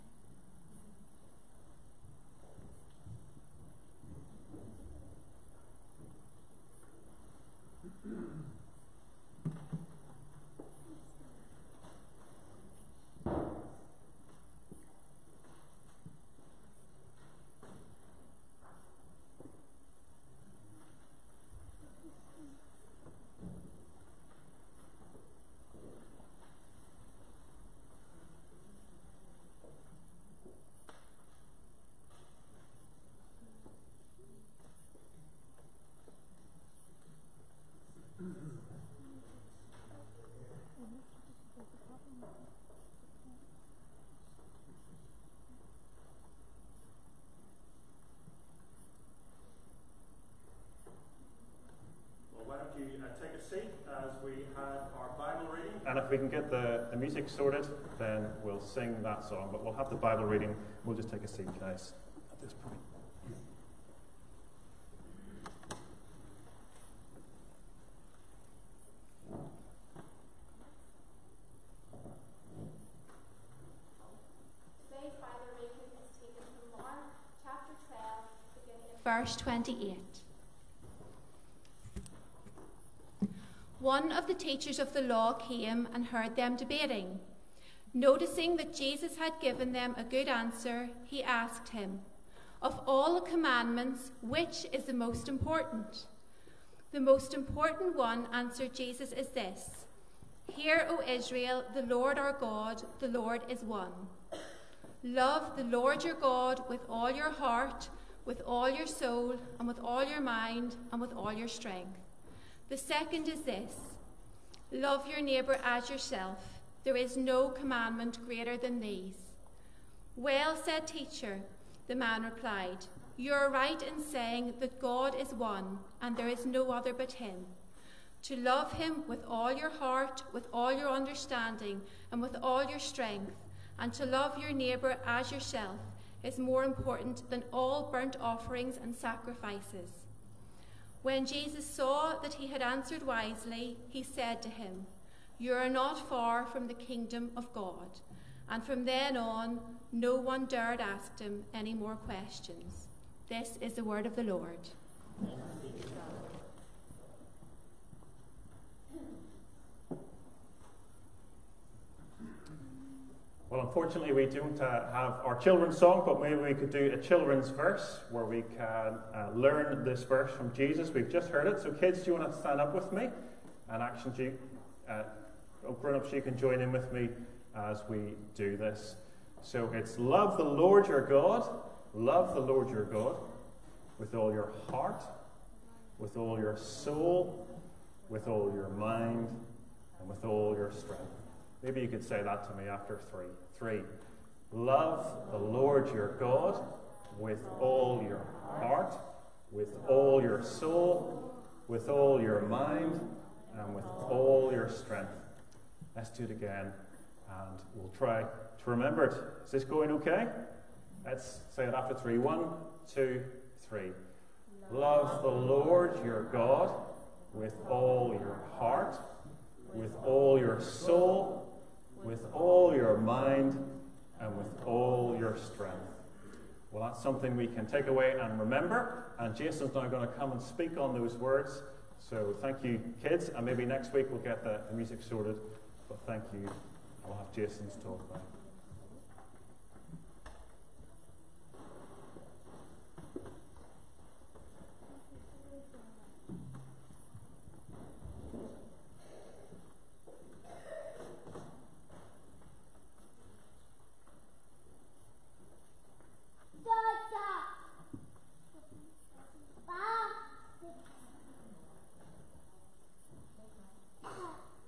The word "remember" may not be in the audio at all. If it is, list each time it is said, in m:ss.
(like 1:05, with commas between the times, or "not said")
3:28, 3:48.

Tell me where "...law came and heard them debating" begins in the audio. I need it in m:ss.
1:25.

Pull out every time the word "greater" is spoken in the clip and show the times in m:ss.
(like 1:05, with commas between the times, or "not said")
1:58.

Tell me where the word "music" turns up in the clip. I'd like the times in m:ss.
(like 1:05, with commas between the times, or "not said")
0:56, 3:54.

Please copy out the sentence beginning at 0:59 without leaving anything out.
But we'll have the Bible reading.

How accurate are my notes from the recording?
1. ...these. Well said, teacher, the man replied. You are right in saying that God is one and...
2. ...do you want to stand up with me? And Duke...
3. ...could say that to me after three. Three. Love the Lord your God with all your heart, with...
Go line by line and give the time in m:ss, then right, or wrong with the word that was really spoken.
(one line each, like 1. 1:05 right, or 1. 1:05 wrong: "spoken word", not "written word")
1. 1:58 right
2. 2:51 wrong: "Action", not "Duke"
3. 3:11 right.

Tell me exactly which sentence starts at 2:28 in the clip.
And from then on, no one dared ask him any more questions.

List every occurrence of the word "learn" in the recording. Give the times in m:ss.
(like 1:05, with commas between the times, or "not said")
2:49.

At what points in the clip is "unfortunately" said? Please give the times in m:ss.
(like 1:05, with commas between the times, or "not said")
2:43.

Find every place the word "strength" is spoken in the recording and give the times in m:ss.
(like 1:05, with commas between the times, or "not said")
1:51, 2:12, 3:10, 3:24, 3:45.